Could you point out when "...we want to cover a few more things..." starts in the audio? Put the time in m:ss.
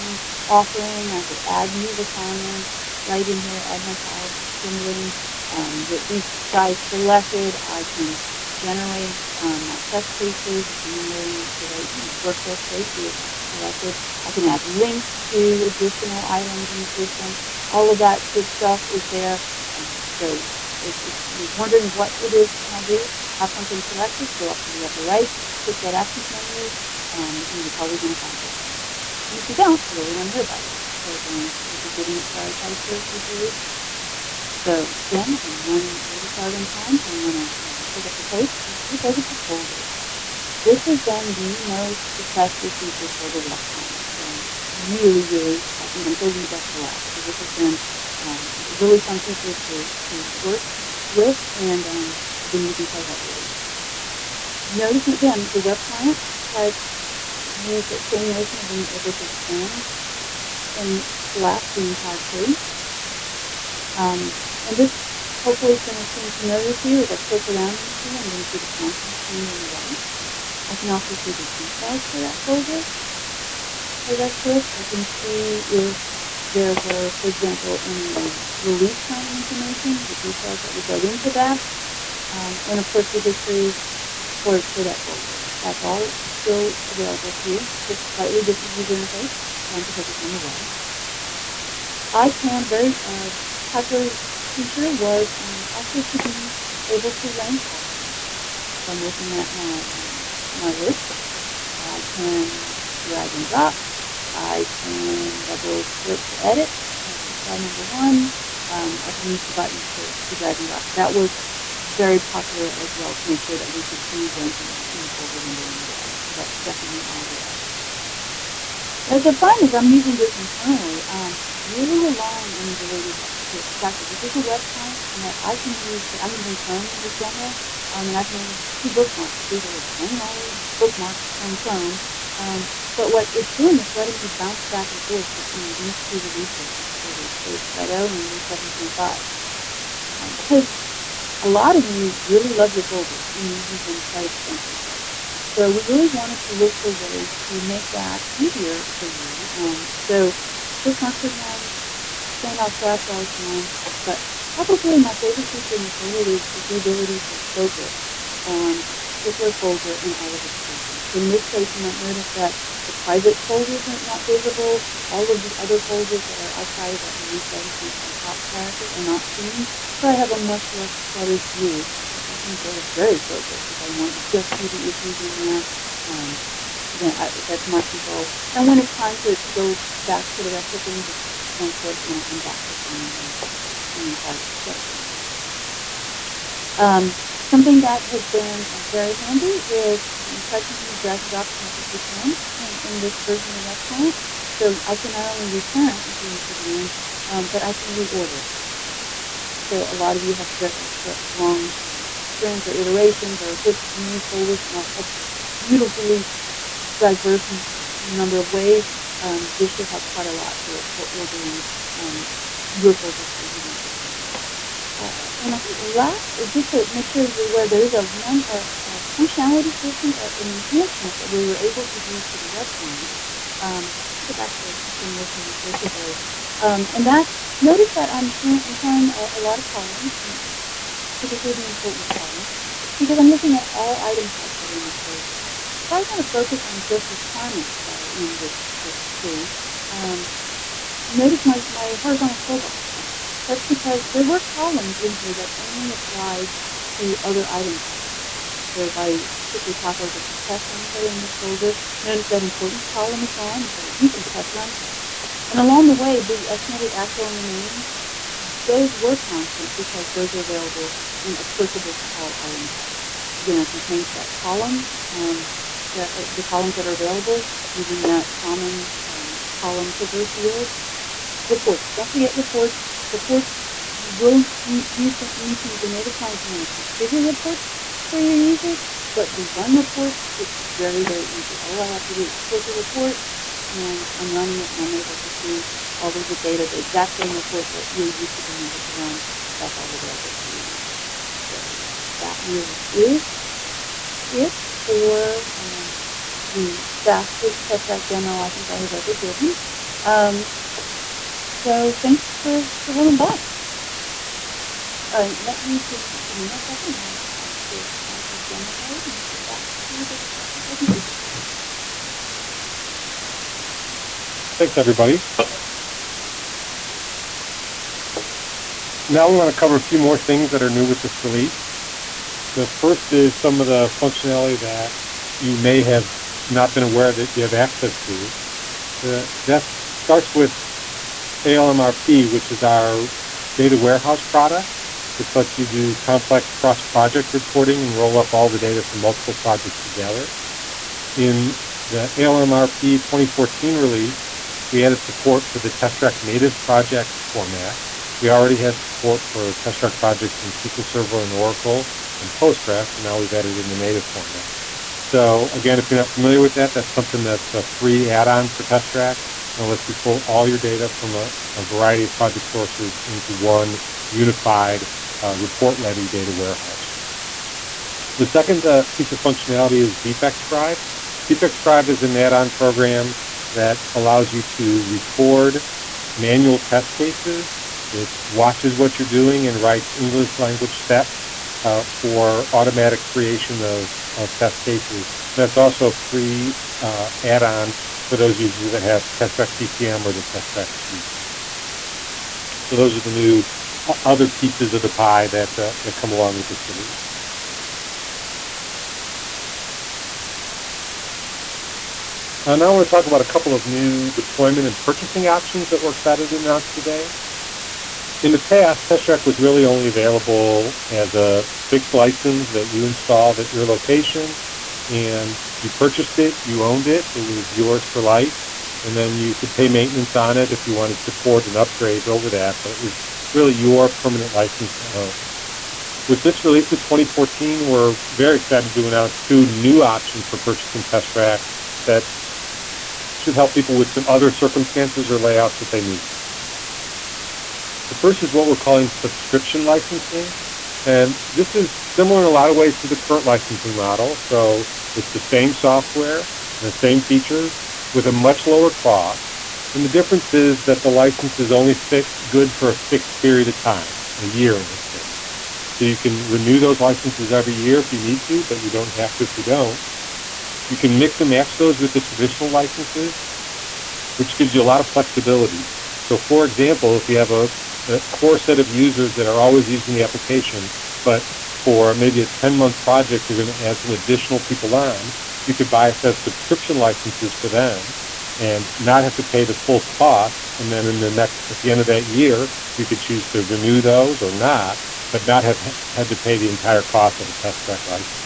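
5:19.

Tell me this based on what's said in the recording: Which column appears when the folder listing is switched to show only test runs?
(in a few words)
test run set.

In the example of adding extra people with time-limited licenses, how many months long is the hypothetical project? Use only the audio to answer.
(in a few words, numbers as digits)
10 months.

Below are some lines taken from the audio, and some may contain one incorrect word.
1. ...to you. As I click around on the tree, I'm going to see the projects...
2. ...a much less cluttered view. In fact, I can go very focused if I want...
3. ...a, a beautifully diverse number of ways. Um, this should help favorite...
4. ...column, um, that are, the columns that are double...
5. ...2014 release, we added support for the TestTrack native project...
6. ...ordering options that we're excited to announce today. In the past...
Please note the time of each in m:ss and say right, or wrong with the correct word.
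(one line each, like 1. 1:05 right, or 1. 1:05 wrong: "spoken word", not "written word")
1. 1:06 wrong: "contents", not "projects"
2. 2:50 right
3. 3:24 wrong: "quite", not "favorite"
4. 4:24 wrong: "available", not "double"
5. 5:43 right
6. 6:44 wrong: "purchasing", not "ordering".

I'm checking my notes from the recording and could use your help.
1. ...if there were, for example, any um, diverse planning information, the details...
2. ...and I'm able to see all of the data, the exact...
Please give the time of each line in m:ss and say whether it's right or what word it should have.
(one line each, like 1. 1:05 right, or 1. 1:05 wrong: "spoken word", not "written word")
1. 1:15 wrong: "release", not "diverse"
2. 4:44 right.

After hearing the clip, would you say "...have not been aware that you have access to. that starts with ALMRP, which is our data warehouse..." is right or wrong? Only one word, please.
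right.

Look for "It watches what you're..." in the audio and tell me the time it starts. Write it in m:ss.
6:17.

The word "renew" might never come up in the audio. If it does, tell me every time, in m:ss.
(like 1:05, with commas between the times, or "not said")
7:36, 8:03.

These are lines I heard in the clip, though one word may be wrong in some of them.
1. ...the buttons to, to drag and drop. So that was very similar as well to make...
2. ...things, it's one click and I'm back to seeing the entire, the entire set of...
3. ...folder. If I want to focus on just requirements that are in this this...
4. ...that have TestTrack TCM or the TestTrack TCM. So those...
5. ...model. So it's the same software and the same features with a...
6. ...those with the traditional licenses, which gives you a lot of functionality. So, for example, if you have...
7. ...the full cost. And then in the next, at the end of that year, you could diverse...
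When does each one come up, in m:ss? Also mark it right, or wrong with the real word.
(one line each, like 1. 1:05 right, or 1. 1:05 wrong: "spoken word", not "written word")
1. 1:49 wrong: "popular", not "similar"
2. 3:00 right
3. 3:55 right
4. 6:28 wrong: "Suite", not "TCM"
5. 7:23 right
6. 7:41 wrong: "flexibility", not "functionality"
7. 7:59 wrong: "choose", not "diverse".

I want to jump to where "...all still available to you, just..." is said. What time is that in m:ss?
1:25.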